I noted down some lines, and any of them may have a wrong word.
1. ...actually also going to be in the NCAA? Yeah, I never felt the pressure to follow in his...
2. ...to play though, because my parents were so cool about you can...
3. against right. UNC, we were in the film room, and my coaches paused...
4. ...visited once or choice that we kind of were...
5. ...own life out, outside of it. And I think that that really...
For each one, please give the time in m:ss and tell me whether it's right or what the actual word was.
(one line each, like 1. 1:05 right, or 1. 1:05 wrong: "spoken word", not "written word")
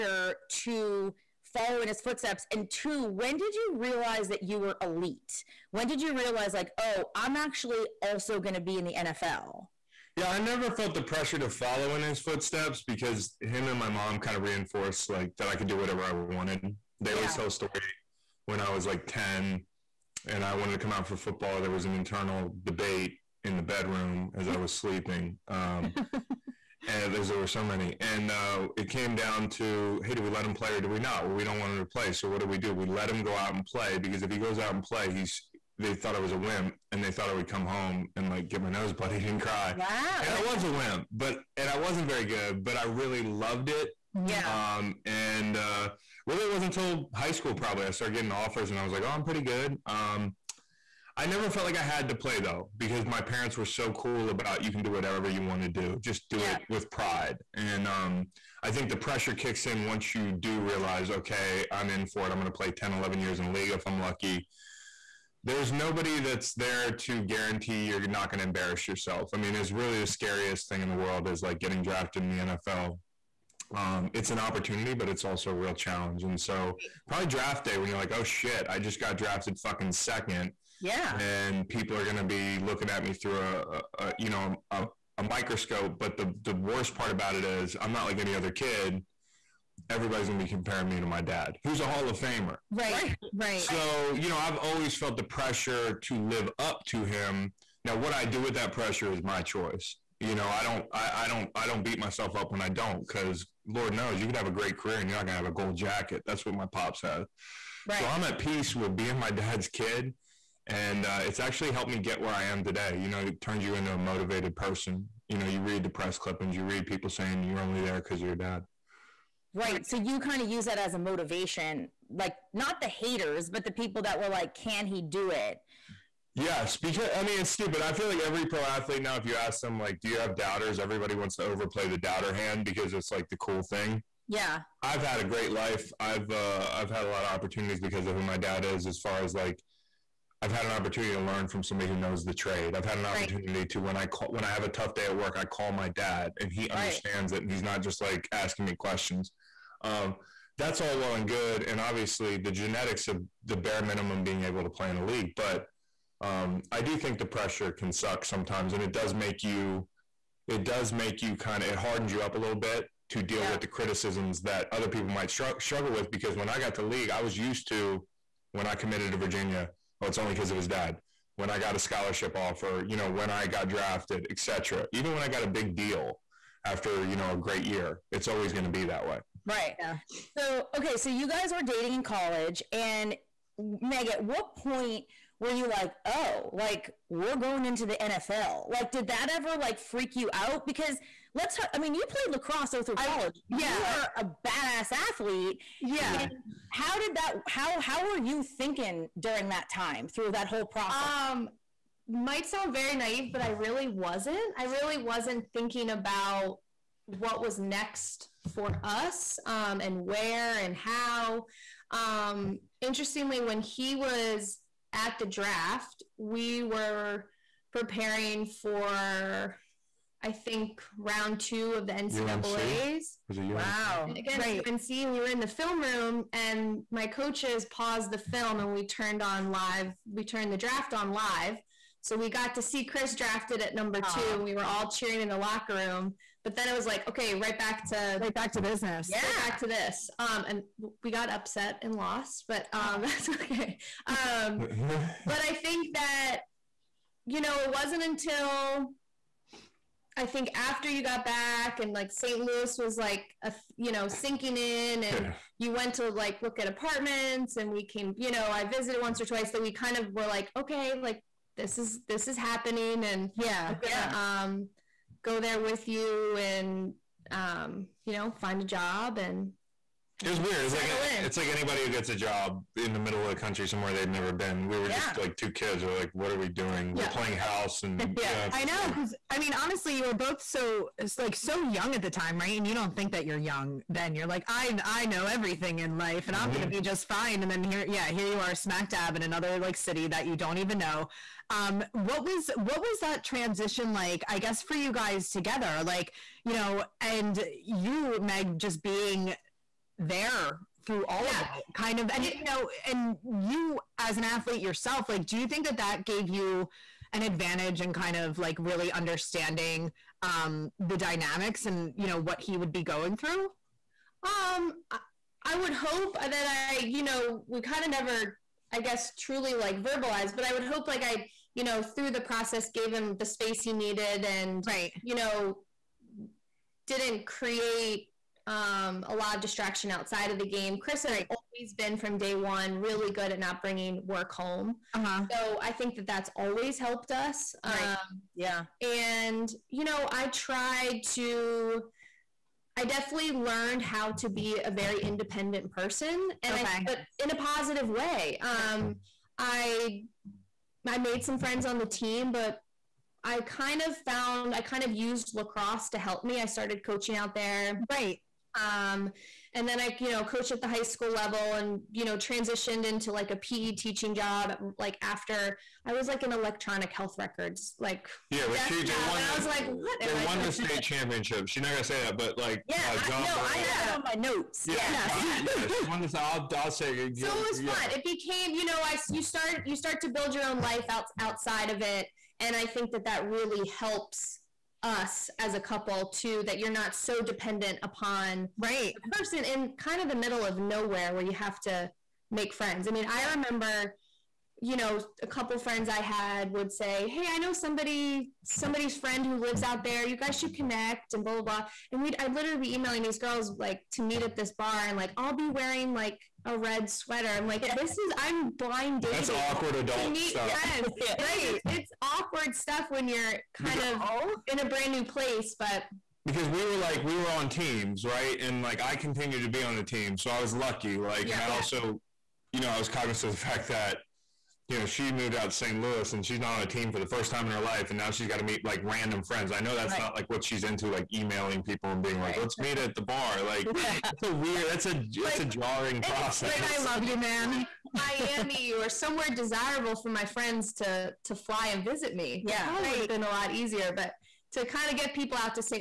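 1. 0:07 wrong: "NFL", not "NCAA"
2. 0:52 right
3. 3:44 right
4. 4:18 wrong: "twice", not "choice"
5. 6:20 right.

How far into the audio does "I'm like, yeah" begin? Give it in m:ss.
6:47.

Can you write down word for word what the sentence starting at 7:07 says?
And now she's got to meet like random friends.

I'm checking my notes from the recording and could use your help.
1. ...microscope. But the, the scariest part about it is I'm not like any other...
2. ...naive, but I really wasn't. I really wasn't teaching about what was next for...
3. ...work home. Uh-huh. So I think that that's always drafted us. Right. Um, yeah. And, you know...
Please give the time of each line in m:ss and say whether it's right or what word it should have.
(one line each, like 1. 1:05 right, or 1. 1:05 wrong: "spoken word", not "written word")
1. 1:25 wrong: "worst", not "scariest"
2. 3:22 wrong: "thinking", not "teaching"
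3. 5:34 wrong: "helped", not "drafted".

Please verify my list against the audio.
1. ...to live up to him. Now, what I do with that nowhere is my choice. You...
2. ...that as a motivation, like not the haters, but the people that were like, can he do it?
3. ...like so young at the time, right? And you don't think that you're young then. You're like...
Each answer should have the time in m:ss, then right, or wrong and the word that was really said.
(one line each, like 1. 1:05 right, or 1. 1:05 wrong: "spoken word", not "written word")
1. 1:36 wrong: "pressure", not "nowhere"
2. 2:00 right
3. 4:41 right.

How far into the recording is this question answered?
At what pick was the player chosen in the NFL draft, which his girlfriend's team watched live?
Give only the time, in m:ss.
3:53.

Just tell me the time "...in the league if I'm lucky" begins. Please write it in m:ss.
1:03.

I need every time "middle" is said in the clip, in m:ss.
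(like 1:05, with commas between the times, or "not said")
4:32, 6:30.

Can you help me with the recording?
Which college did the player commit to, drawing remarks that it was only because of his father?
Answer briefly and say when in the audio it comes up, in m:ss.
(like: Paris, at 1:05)
Virginia, at 2:49.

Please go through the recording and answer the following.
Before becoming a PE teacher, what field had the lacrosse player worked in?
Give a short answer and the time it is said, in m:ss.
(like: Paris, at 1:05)
electronic health records, at 6:06.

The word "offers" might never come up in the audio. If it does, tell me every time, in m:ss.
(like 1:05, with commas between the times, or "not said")
0:48, 2:52.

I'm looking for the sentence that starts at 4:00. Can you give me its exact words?
Um, and we got upset and lost, but um, that's okay.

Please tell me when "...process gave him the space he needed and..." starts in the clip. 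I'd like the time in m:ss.
5:22.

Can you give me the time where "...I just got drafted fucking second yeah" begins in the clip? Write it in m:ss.
1:18.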